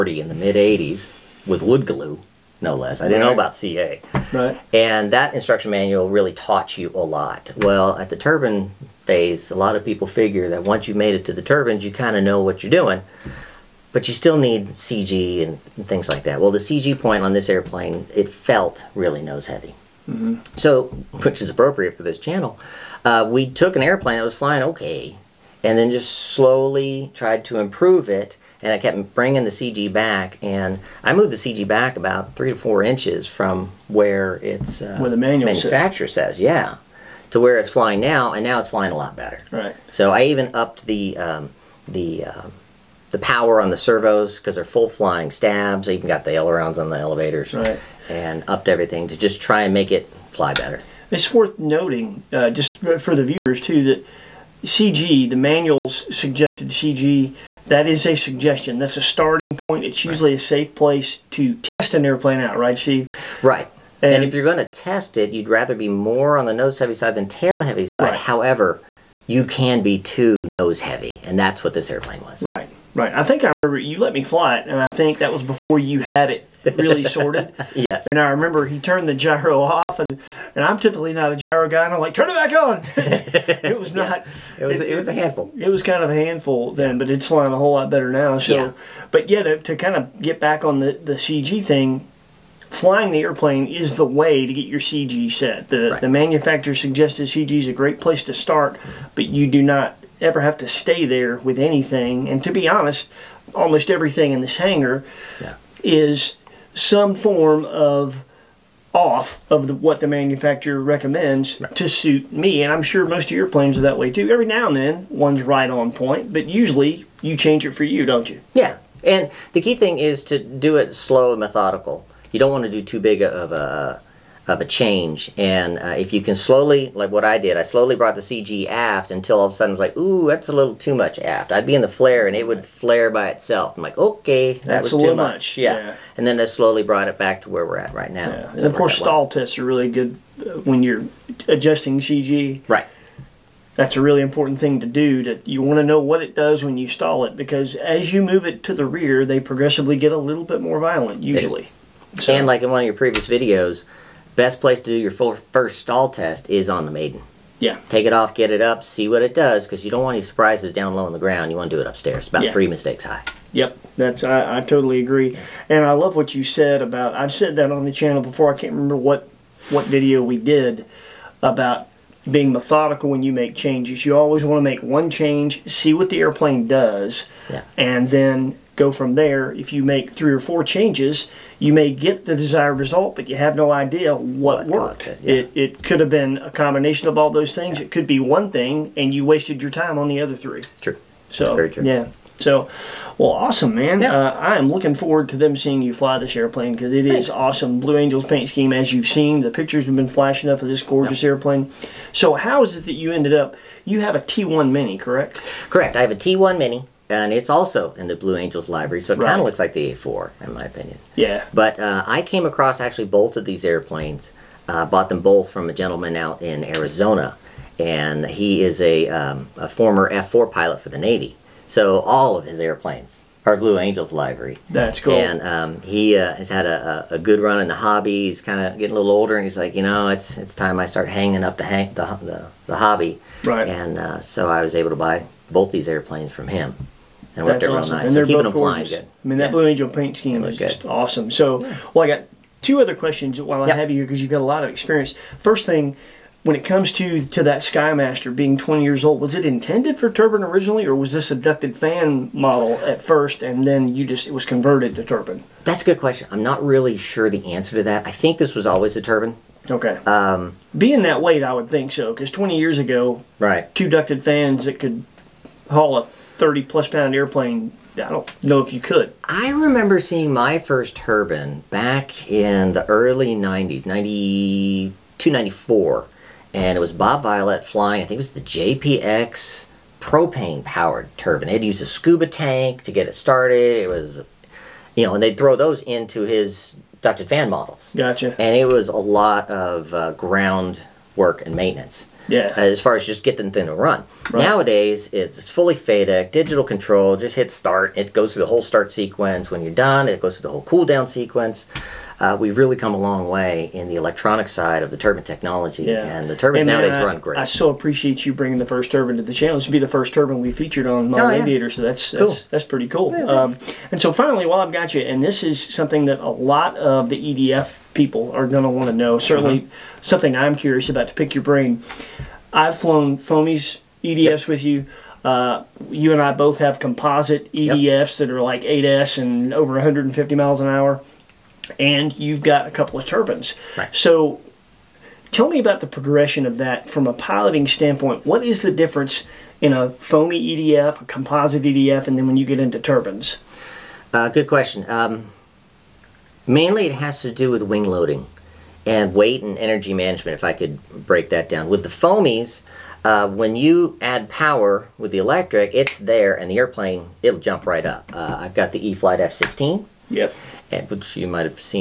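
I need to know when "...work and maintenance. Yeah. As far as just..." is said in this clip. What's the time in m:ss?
4:51.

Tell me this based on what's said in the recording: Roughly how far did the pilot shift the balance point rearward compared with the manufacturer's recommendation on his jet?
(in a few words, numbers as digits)
3 to 4 inches.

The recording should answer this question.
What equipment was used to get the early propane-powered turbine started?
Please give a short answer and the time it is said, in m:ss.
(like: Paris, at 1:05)
A scuba tank, at 4:41.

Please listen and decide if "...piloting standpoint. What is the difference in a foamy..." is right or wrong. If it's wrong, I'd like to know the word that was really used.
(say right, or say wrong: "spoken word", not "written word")
right.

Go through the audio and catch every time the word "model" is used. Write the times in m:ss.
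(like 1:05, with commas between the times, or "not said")
4:12, 4:47.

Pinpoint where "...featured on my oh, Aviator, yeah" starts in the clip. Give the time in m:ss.
5:10.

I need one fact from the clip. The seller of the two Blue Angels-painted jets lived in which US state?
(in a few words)
Arizona.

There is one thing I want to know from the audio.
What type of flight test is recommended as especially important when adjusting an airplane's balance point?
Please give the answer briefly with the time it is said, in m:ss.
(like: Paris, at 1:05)
Stall tests, at 2:18.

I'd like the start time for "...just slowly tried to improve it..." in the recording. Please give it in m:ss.
0:25.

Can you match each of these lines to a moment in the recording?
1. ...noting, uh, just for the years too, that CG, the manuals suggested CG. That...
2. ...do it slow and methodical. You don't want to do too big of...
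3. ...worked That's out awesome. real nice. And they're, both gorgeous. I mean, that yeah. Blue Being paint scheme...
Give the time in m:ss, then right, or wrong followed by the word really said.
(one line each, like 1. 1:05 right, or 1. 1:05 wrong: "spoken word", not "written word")
1. 0:51 wrong: "viewers", not "years"
2. 2:00 right
3. 3:57 wrong: "Angel", not "Being".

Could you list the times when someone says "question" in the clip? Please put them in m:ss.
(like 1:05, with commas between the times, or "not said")
4:02, 4:16, 5:44.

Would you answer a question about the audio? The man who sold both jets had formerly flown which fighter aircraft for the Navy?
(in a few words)
F4.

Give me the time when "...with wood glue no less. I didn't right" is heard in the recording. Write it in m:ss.
0:01.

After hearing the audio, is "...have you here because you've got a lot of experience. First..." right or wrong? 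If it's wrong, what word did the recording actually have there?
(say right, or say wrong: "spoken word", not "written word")
right.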